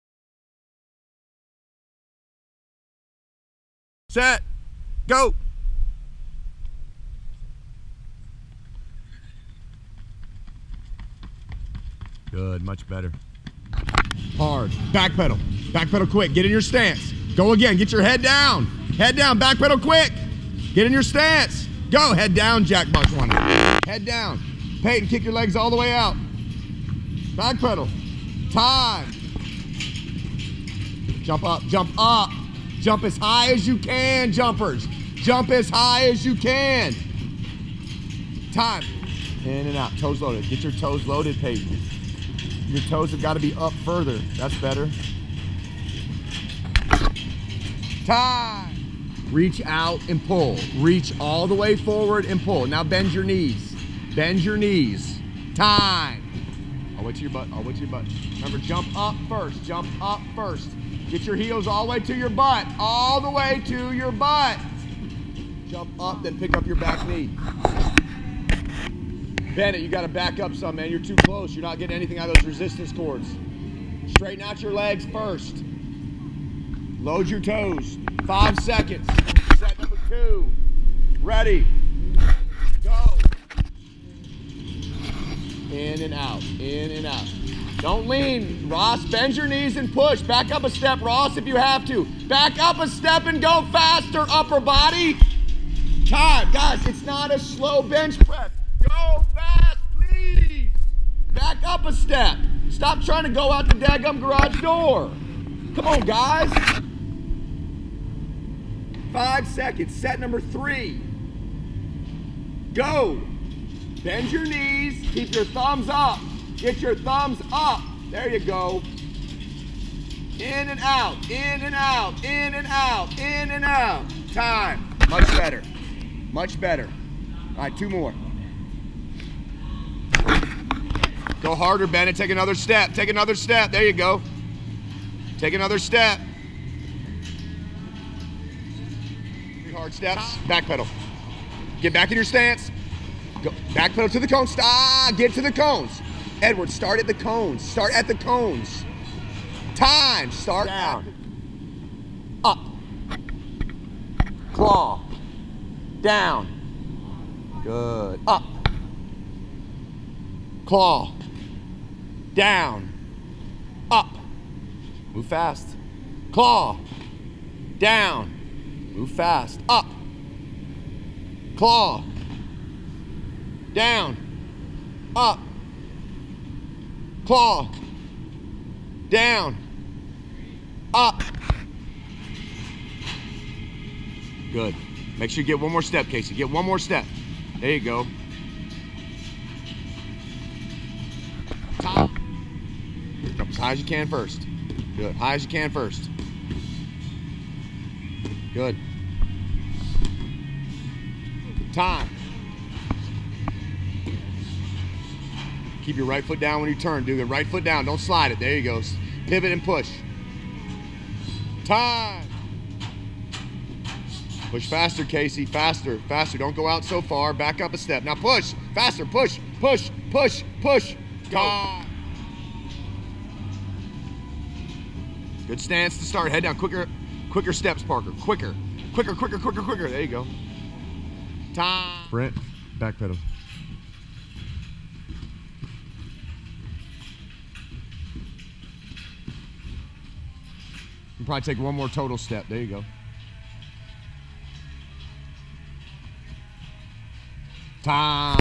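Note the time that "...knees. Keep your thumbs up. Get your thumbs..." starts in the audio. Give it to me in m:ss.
1:54.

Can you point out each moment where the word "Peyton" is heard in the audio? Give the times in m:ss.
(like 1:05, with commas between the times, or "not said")
0:24, 0:41.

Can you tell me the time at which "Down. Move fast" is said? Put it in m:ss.
2:47.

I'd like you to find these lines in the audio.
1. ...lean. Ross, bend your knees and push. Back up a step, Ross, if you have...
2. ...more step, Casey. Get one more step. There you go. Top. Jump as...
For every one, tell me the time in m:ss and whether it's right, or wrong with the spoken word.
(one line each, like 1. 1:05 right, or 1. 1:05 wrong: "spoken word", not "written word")
1. 1:28 right
2. 3:05 right.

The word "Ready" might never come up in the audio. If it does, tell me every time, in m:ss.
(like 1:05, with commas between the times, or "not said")
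1:21.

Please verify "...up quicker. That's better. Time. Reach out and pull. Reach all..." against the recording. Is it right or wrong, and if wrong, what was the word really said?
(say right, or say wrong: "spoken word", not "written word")
wrong: "further", not "quicker".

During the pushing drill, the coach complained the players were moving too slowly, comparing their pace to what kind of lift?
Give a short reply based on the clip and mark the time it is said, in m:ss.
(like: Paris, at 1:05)
slow bench press, at 1:37.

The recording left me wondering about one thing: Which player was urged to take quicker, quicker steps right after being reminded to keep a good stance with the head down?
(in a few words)
Parker.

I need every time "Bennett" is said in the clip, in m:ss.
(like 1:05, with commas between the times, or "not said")
1:09, 2:11.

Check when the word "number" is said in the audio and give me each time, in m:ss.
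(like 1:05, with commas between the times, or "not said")
1:19, 1:50.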